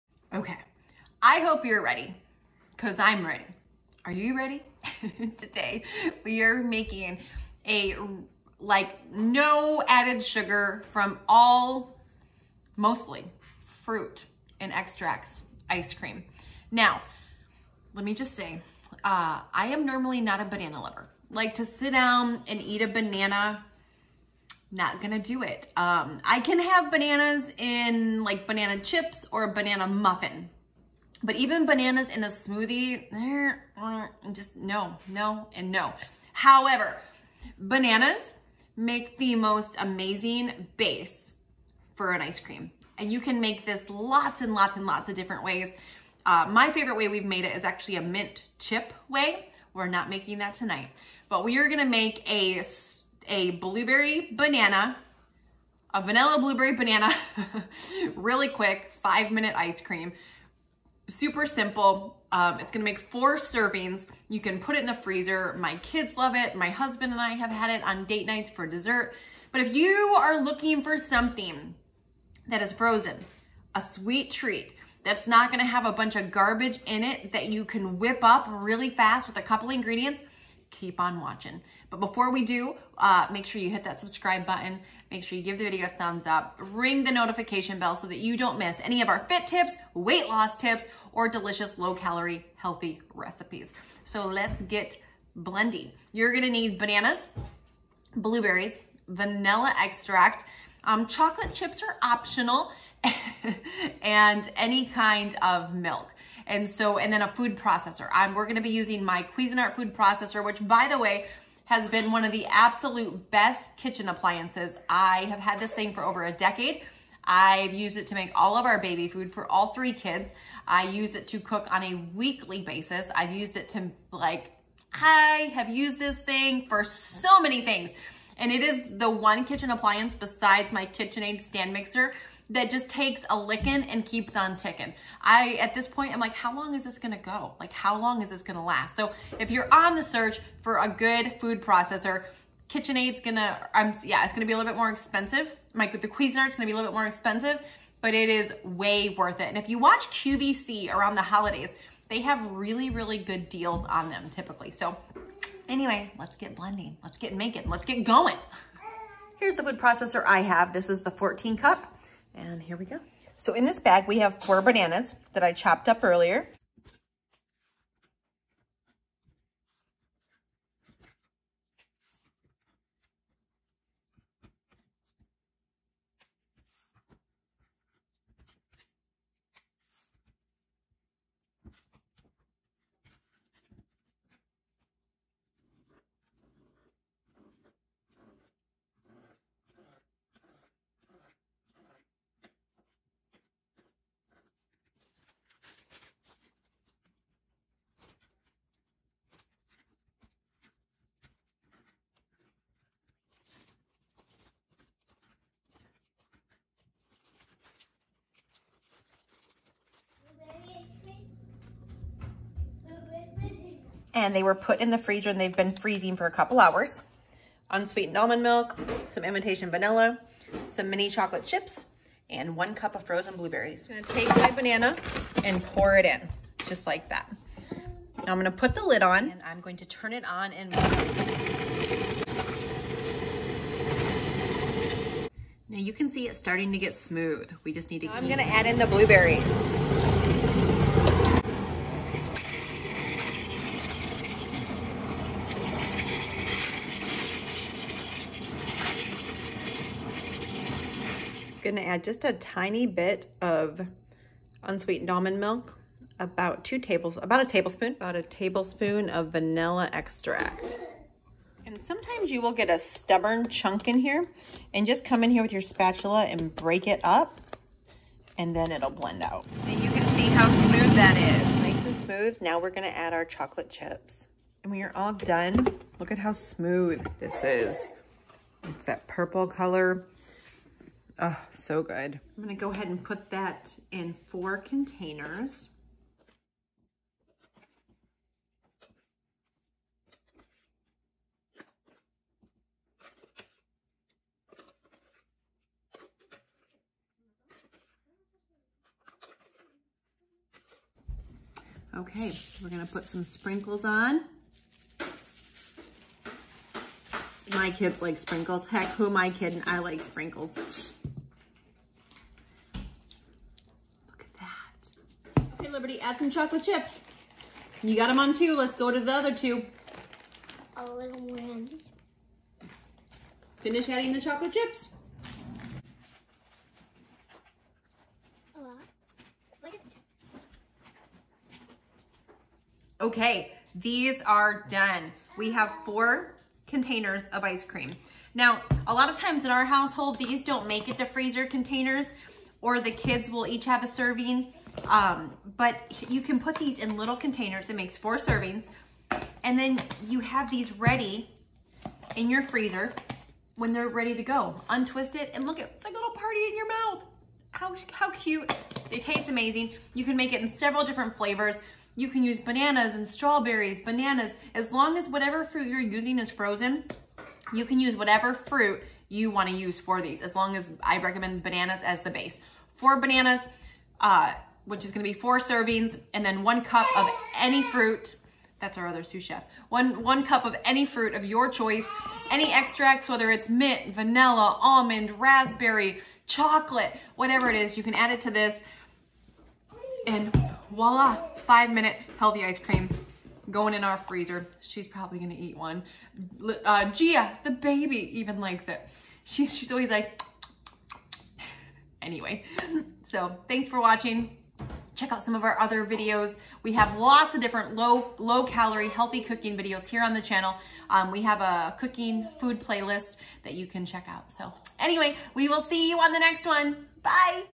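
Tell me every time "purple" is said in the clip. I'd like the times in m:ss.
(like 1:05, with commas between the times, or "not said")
4:39.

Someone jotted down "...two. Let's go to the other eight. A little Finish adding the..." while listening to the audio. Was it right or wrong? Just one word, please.
wrong.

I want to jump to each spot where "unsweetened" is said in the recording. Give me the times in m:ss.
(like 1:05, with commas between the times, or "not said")
3:37, 4:14.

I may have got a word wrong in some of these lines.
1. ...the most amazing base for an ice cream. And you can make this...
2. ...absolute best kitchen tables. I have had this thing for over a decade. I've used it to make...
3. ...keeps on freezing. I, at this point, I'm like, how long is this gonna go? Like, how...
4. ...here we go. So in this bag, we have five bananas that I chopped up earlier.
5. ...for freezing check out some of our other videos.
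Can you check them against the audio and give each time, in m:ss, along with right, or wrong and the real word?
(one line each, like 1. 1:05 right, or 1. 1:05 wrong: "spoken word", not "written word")
1. 0:39 right
2. 1:52 wrong: "appliances", not "tables"
3. 2:14 wrong: "ticking", not "freezing"
4. 2:42 wrong: "four", not "five"
5. 6:43 wrong: "watching", not "freezing".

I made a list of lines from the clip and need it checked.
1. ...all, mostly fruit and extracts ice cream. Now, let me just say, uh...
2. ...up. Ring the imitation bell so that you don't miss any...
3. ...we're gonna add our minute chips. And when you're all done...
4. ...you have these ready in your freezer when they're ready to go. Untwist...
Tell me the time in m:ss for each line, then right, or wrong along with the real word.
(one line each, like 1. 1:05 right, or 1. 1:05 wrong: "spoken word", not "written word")
1. 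0:11 right
2. 1:26 wrong: "notification", not "imitation"
3. 4:32 wrong: "chocolate", not "minute"
4. 5:50 right.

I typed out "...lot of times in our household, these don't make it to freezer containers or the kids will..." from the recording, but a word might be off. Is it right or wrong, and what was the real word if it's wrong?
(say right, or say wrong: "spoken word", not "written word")
right.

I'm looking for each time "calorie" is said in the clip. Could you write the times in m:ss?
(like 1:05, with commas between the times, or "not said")
1:31, 6:48.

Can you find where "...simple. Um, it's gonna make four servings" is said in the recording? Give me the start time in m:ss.
1:01.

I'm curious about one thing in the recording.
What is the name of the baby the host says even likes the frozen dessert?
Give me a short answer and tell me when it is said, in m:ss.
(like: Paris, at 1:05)
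Gia, at 6:36.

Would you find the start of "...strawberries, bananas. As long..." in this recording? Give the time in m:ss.
6:03.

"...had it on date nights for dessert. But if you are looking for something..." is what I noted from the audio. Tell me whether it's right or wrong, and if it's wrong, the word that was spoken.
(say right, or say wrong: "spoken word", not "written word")
right.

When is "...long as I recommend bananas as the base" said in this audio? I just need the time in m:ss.
6:10.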